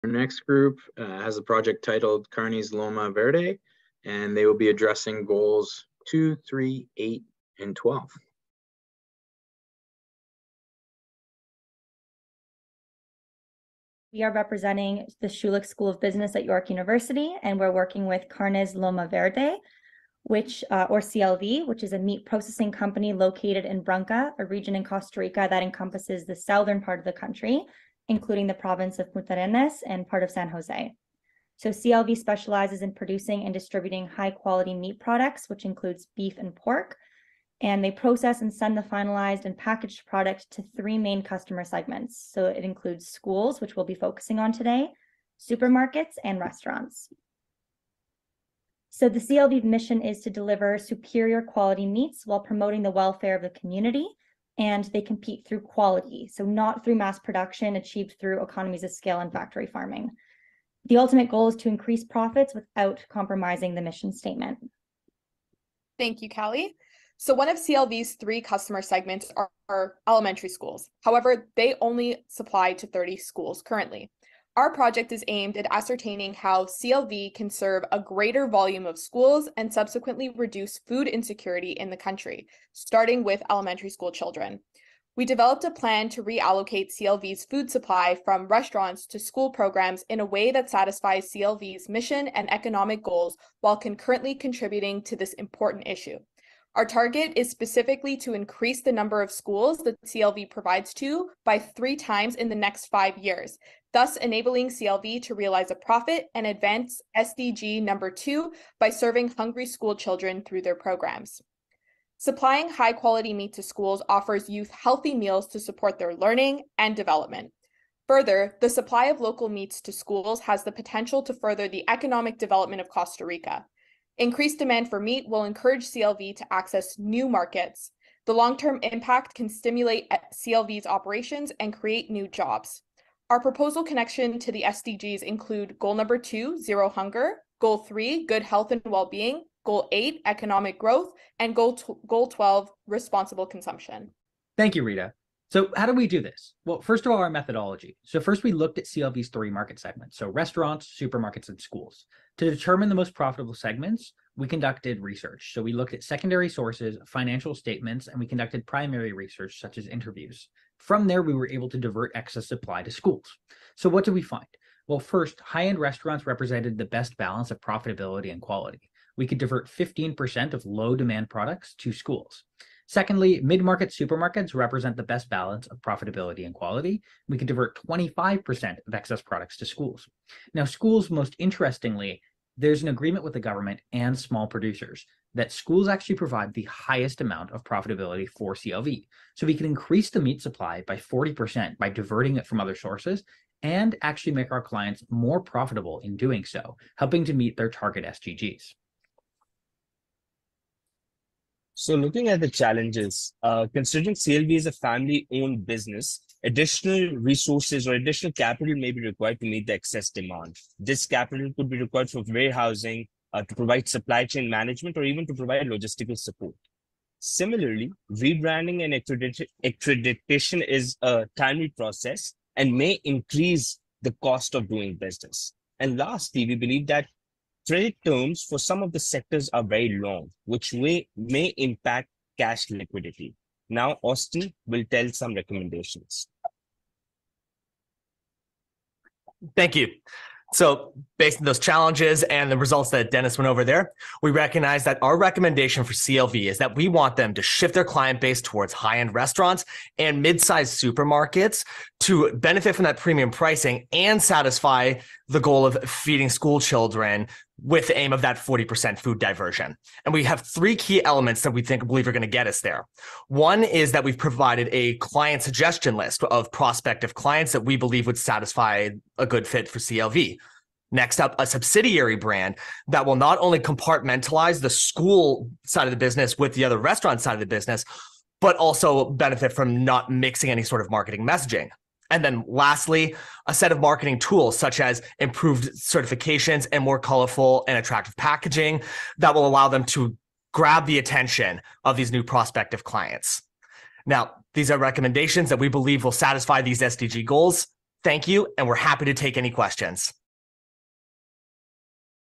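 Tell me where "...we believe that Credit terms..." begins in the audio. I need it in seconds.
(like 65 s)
226 s.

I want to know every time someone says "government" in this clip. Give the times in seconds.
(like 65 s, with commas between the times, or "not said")
183 s.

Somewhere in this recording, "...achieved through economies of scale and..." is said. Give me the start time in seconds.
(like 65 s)
57 s.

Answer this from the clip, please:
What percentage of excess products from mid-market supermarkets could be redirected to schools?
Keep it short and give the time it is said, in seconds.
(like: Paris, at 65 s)
25%, at 177 s.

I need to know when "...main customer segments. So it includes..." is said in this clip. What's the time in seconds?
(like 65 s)
40 s.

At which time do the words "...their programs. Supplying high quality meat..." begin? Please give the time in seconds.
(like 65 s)
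110 s.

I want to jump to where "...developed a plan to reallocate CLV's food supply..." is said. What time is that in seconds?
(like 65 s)
85 s.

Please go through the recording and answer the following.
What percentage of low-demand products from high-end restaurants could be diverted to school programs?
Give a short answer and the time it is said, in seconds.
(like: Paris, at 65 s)
15%, at 169 s.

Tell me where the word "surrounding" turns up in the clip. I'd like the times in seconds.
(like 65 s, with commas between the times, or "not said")
not said.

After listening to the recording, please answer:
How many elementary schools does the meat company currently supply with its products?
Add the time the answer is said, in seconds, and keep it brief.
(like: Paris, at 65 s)
30, at 72 s.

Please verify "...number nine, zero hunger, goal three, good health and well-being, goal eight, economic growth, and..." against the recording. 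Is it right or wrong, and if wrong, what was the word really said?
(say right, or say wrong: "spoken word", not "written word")
wrong: "two", not "nine".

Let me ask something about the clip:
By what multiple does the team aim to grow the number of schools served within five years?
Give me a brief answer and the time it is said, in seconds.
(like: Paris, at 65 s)
Three times, at 101 s.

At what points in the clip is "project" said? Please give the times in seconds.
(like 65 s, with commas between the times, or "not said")
1 s, 74 s.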